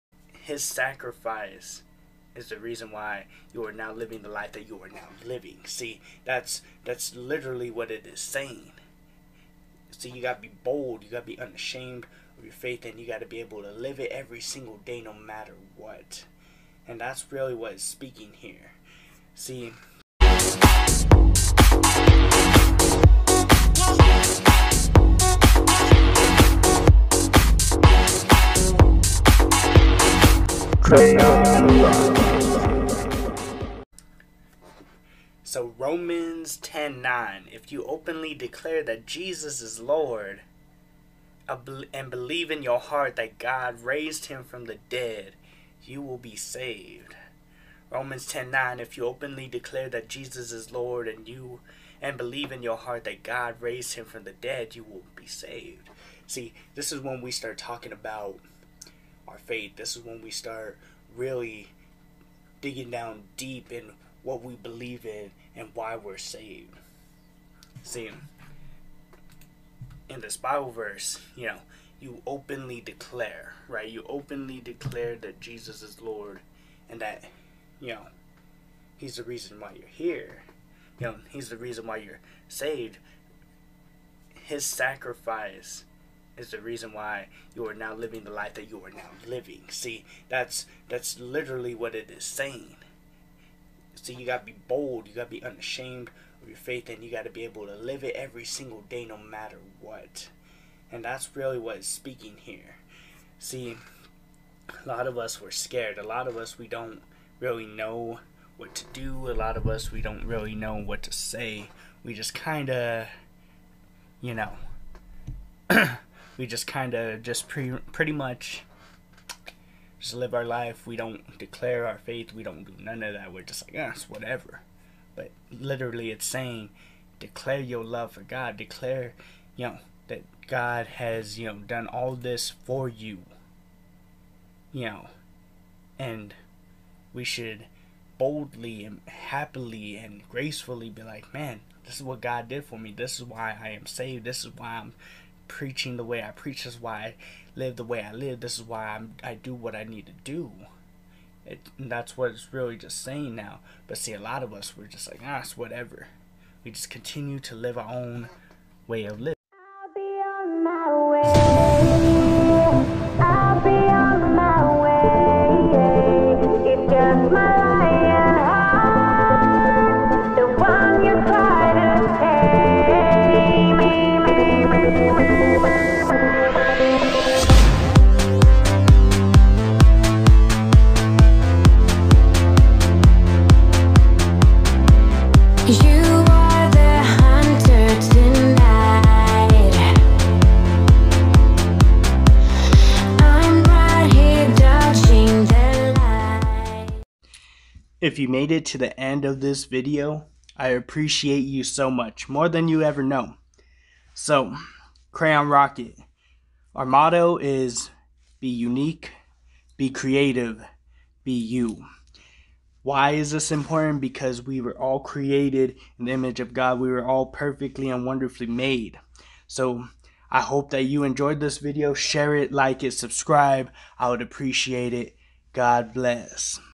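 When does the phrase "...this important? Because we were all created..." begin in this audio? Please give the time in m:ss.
3:33.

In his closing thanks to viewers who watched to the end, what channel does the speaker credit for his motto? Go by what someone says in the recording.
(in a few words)
Krayonn Rocket.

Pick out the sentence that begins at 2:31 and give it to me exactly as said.
It, that's what it's really just saying now.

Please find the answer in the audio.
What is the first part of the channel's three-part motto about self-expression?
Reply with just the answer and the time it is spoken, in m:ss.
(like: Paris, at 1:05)
Be unique, at 3:28.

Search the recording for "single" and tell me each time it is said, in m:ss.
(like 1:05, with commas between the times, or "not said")
0:14, 1:38.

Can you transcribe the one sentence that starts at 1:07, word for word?
See, in this Bible verse, you know, you openly declare, right?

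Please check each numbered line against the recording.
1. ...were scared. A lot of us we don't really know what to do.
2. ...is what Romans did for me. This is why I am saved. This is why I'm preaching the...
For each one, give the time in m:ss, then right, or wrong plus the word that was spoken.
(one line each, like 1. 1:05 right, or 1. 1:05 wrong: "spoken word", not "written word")
1. 1:45 right
2. 2:21 wrong: "God", not "Romans".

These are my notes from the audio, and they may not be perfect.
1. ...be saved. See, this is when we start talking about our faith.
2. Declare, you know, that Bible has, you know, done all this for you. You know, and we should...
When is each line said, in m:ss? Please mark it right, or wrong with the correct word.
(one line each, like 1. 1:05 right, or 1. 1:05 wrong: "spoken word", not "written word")
1. 0:55 right
2. 2:08 wrong: "God", not "Bible".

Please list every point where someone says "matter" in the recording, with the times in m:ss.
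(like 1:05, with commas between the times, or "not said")
0:15, 1:39.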